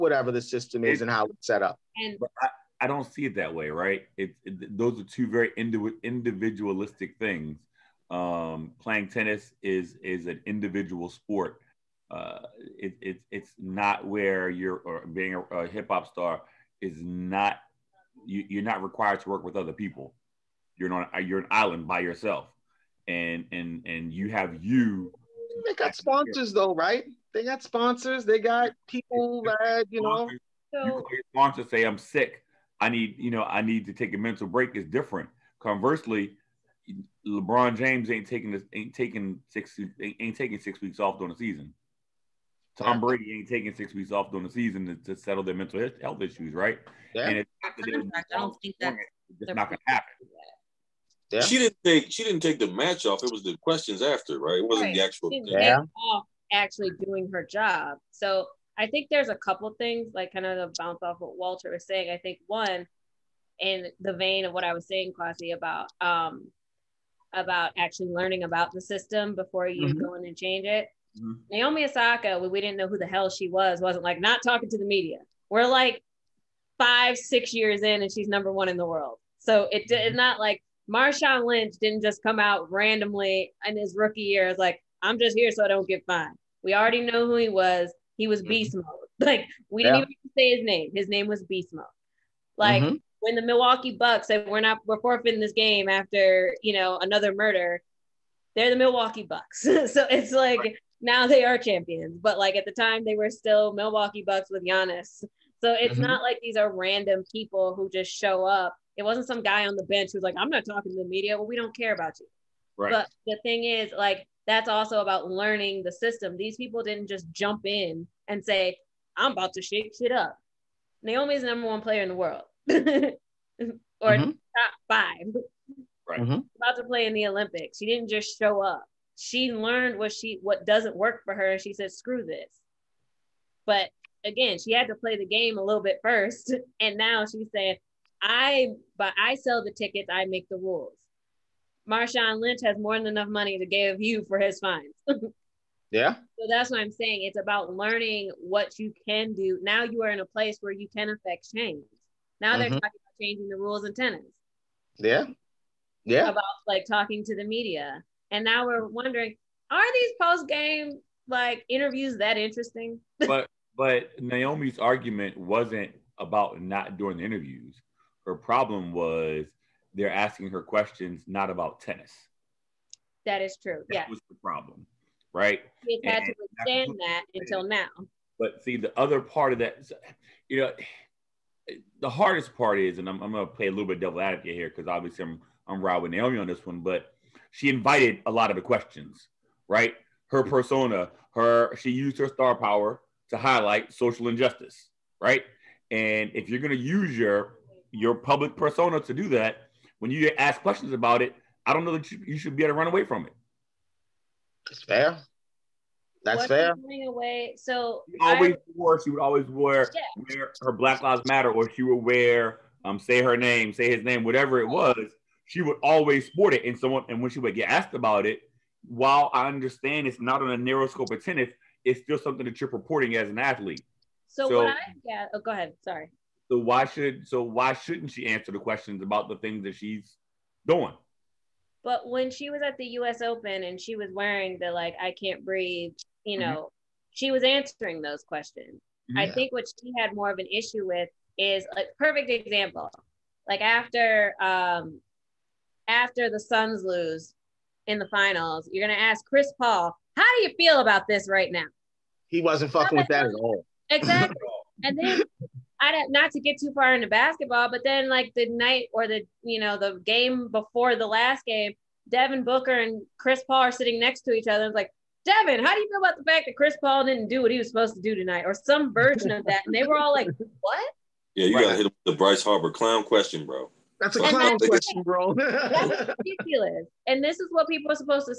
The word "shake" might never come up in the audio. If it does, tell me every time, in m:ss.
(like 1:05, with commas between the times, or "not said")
1:59.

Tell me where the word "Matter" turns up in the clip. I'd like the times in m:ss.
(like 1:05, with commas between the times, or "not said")
3:31.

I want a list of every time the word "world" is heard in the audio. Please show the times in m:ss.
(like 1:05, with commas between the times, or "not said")
1:18, 2:02.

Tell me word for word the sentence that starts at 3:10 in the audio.
Her persona, her she used her star power to highlight social injustice, right?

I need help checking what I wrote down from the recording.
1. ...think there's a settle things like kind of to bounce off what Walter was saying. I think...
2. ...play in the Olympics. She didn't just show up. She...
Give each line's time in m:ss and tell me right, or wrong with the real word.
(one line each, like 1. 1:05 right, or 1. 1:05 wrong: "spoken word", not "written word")
1. 0:58 wrong: "couple", not "settle"
2. 2:06 right.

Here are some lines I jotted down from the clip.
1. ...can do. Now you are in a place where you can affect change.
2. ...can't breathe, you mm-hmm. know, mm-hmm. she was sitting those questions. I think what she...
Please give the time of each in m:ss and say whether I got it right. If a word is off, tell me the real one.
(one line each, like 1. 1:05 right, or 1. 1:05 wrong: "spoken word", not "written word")
1. 2:29 right
2. 3:55 wrong: "answering", not "sitting".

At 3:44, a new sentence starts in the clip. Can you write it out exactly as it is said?
So, so what I yeah, oh, go ahead.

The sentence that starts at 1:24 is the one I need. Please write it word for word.
It's like, I'm just here so I don't get fined.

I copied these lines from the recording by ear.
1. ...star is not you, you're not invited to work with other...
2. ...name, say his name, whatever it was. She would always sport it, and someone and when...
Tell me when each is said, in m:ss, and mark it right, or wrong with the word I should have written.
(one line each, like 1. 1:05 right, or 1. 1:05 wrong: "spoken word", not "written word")
1. 0:16 wrong: "required", not "invited"
2. 3:33 right.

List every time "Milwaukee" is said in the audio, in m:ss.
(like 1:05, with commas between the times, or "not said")
1:33, 1:38, 1:43.